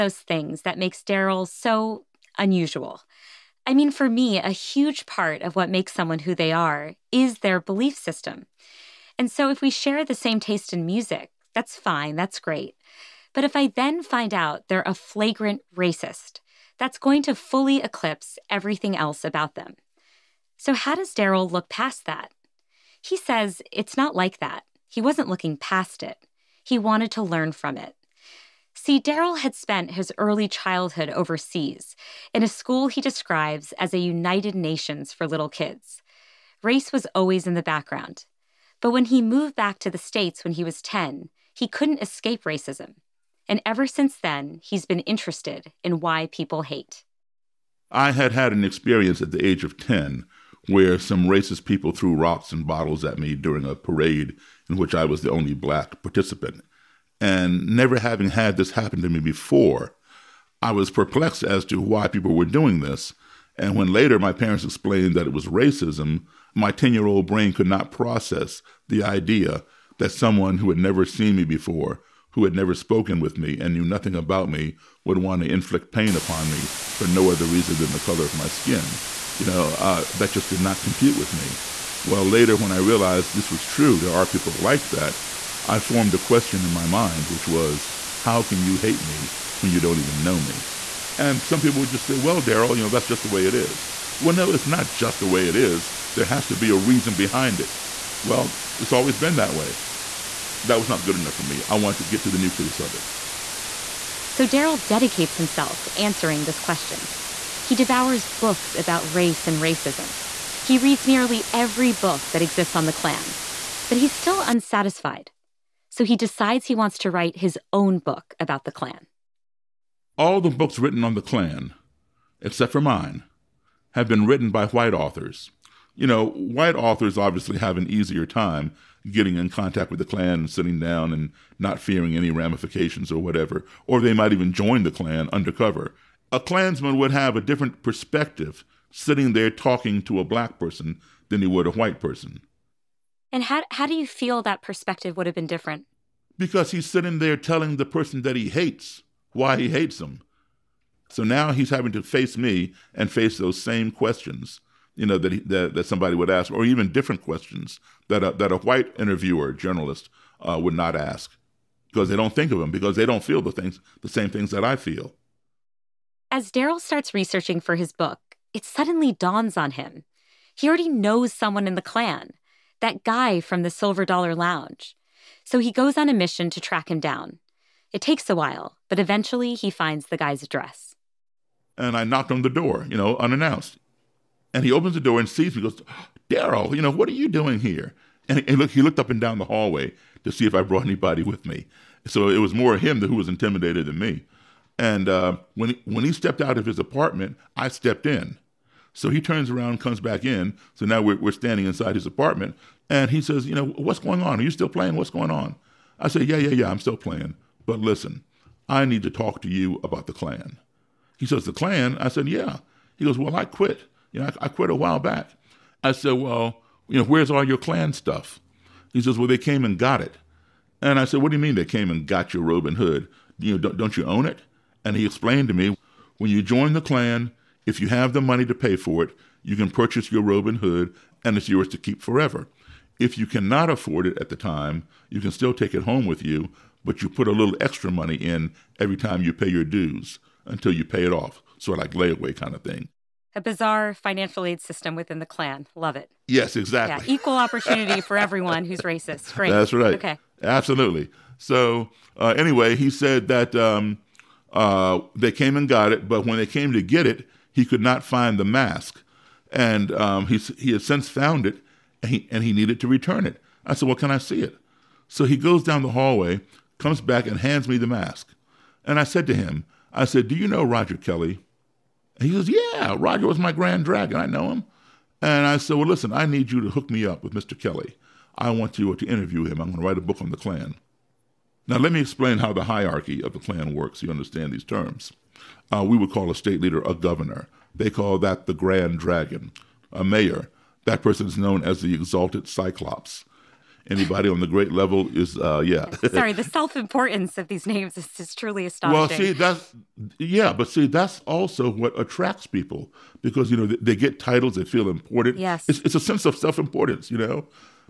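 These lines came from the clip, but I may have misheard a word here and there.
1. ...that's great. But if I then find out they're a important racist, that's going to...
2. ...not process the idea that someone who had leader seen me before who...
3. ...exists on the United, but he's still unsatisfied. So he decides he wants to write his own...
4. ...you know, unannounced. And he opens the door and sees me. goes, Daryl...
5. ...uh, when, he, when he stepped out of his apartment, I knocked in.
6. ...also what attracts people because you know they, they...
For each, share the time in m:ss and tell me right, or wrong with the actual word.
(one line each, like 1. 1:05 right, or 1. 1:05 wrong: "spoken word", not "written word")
1. 0:12 wrong: "flagrant", not "important"
2. 1:07 wrong: "never", not "leader"
3. 1:52 wrong: "Klan", not "United"
4. 3:02 right
5. 3:15 wrong: "stepped", not "knocked"
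6. 5:01 right.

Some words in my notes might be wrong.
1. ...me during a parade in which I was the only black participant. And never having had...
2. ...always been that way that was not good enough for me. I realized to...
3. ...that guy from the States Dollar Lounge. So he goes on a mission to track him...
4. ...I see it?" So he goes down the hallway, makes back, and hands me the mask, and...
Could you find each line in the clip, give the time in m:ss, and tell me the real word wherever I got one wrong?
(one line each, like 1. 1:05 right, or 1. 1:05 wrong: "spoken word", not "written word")
1. 0:53 right
2. 1:38 wrong: "wanted", not "realized"
3. 2:52 wrong: "Silver", not "States"
4. 4:24 wrong: "comes", not "makes".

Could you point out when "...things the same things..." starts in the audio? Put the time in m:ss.
2:43.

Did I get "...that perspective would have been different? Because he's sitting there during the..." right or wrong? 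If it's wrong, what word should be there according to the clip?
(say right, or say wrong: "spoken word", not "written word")
wrong: "telling", not "during".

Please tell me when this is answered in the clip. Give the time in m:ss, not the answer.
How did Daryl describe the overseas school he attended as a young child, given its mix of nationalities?
0:33.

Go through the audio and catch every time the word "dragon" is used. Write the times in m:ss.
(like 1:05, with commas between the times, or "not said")
4:33, 4:48.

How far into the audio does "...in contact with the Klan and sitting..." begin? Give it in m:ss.
2:09.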